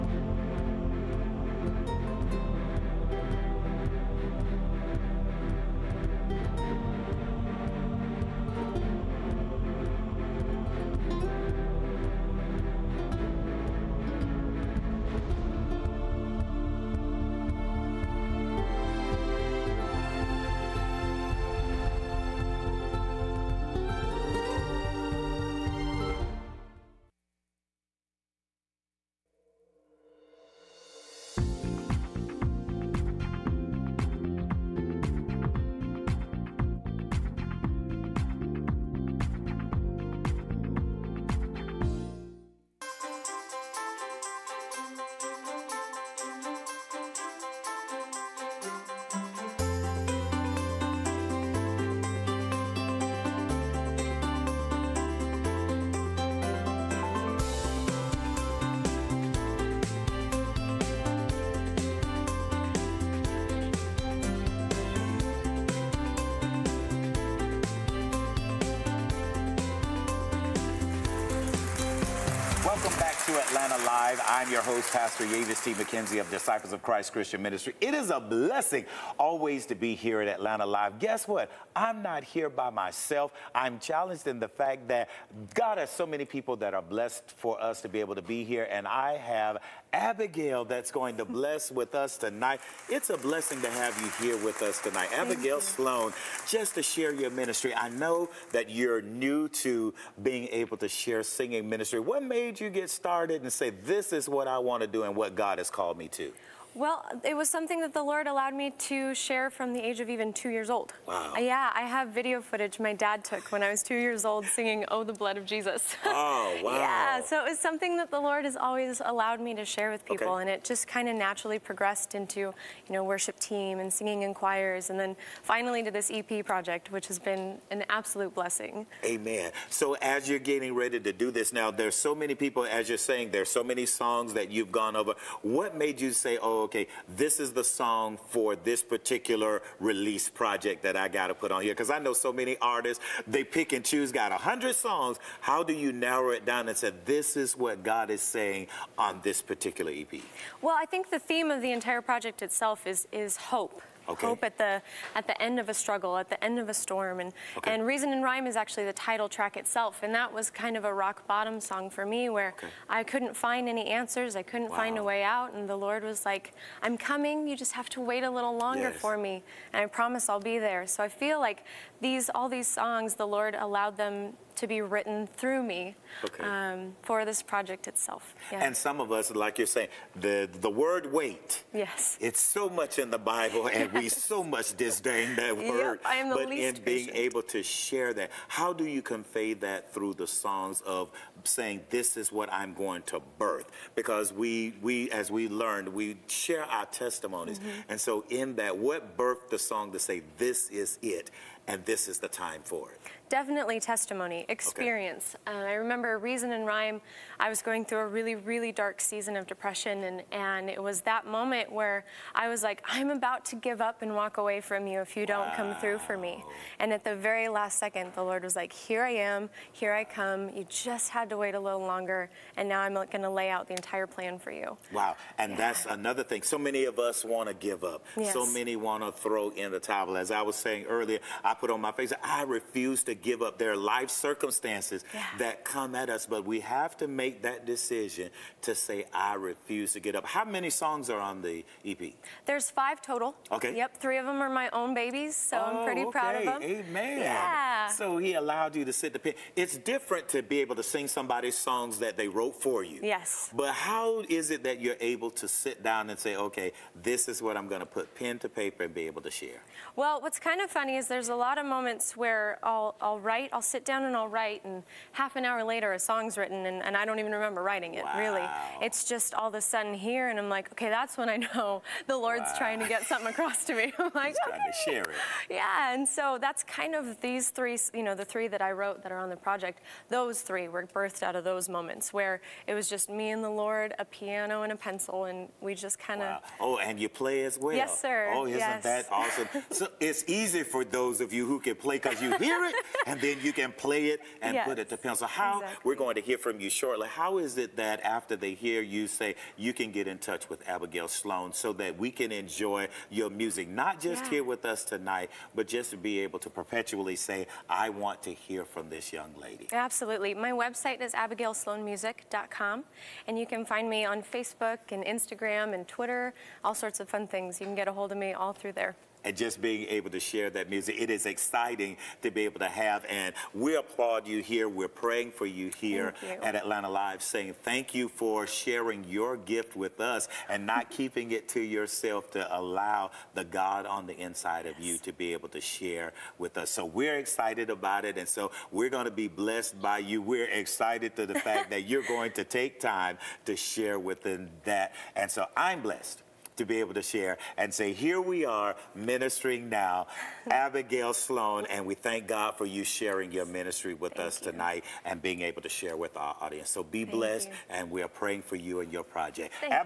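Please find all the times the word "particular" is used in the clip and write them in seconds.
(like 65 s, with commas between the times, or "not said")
138 s, 149 s.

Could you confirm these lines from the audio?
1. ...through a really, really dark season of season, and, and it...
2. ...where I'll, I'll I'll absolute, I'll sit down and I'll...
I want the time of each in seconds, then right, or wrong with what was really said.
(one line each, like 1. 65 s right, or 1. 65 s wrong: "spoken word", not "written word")
1. 207 s wrong: "depression", not "season"
2. 262 s wrong: "write", not "absolute".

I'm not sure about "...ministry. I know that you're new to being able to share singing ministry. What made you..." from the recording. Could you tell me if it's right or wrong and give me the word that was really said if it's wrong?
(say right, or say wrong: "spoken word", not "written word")
right.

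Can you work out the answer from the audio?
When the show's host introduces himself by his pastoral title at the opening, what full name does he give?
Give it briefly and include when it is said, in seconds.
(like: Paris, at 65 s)
Yavis T. McKenzie, at 75 s.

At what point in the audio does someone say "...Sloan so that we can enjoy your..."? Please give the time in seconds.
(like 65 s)
301 s.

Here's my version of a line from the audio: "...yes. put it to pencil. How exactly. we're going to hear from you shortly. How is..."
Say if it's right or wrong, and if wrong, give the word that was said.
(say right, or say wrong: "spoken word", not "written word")
right.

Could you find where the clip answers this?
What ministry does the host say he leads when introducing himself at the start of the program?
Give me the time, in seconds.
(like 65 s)
76 s.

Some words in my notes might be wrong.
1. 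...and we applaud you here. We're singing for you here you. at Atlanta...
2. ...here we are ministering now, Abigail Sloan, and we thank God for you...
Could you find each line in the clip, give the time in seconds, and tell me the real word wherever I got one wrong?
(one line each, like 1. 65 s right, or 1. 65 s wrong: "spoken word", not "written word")
1. 323 s wrong: "praying", not "singing"
2. 347 s right.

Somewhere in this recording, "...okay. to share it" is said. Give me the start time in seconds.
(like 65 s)
274 s.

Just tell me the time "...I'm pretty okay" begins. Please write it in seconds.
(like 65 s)
245 s.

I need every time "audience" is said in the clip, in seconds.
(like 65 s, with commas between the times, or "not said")
356 s.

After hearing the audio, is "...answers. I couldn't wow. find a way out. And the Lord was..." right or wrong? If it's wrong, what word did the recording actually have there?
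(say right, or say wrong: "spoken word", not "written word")
right.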